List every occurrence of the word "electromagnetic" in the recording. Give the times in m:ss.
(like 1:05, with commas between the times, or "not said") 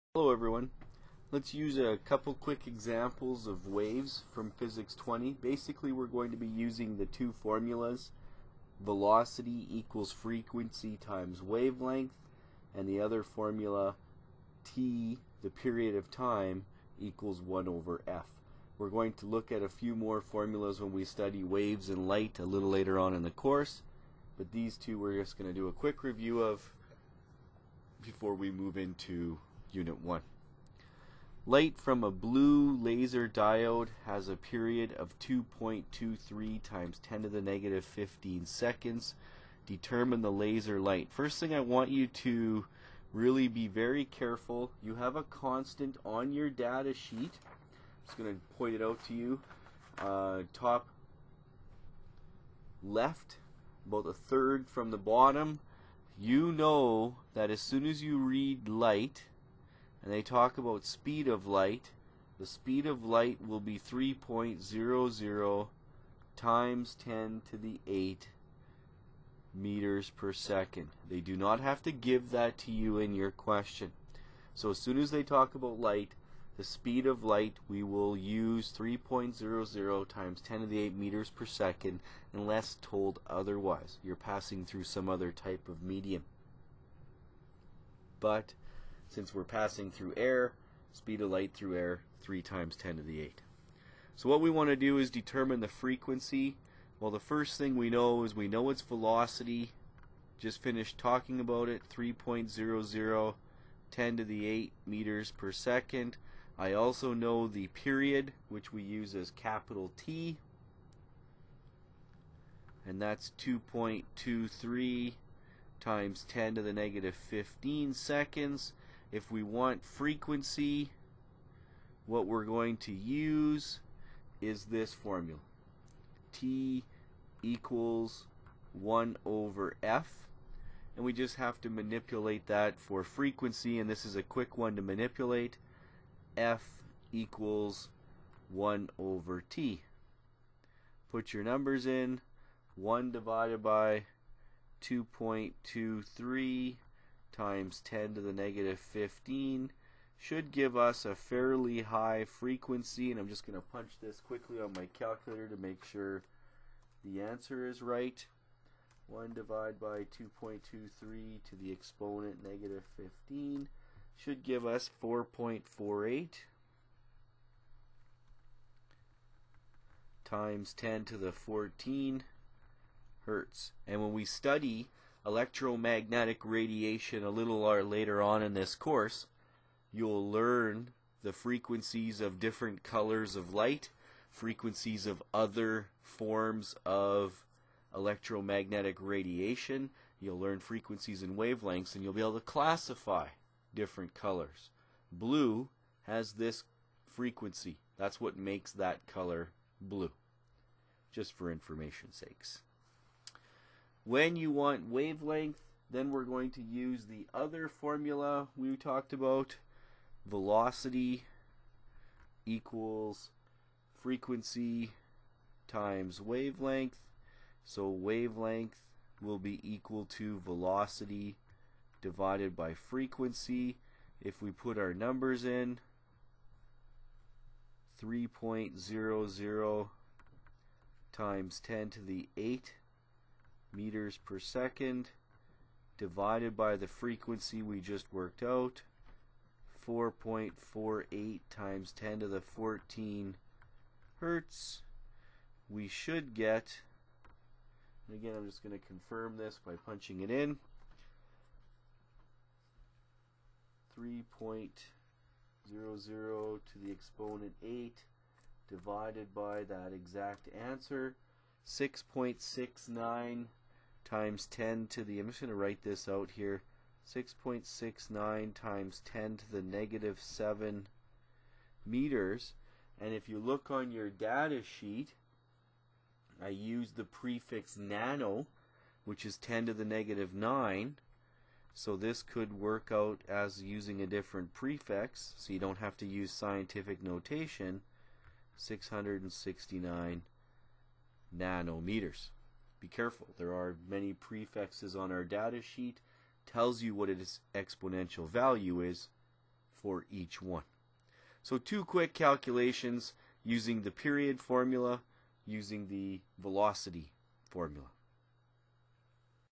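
2:55, 3:07.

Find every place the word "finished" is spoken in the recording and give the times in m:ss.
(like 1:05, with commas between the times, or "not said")
1:40.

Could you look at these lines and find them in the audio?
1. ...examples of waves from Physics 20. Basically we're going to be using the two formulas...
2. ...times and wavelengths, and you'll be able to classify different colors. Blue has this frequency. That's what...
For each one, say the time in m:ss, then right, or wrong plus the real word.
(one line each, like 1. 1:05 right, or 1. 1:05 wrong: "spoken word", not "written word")
1. 0:02 right
2. 3:10 wrong: "frequencies", not "times".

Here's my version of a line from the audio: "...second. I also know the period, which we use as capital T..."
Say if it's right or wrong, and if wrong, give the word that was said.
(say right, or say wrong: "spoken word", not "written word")
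right.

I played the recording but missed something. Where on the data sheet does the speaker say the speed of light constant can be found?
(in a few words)
top left.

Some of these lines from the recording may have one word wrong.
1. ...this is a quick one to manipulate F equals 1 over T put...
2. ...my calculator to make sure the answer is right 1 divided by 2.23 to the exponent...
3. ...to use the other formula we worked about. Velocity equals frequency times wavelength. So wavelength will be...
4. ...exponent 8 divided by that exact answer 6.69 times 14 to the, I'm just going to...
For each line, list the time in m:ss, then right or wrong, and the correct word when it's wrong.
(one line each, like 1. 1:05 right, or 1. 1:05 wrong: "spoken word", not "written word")
1. 2:13 right
2. 2:34 right
3. 3:26 wrong: "talked", not "worked"
4. 4:16 wrong: "10", not "14".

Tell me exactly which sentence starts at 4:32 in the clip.
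And if you look on your data sheet, I use the prefix nano, which is 10 to the negative 9.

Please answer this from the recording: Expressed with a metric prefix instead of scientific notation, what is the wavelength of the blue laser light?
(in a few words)
669 nanometers.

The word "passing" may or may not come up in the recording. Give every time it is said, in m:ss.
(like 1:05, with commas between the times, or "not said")
1:24, 1:29.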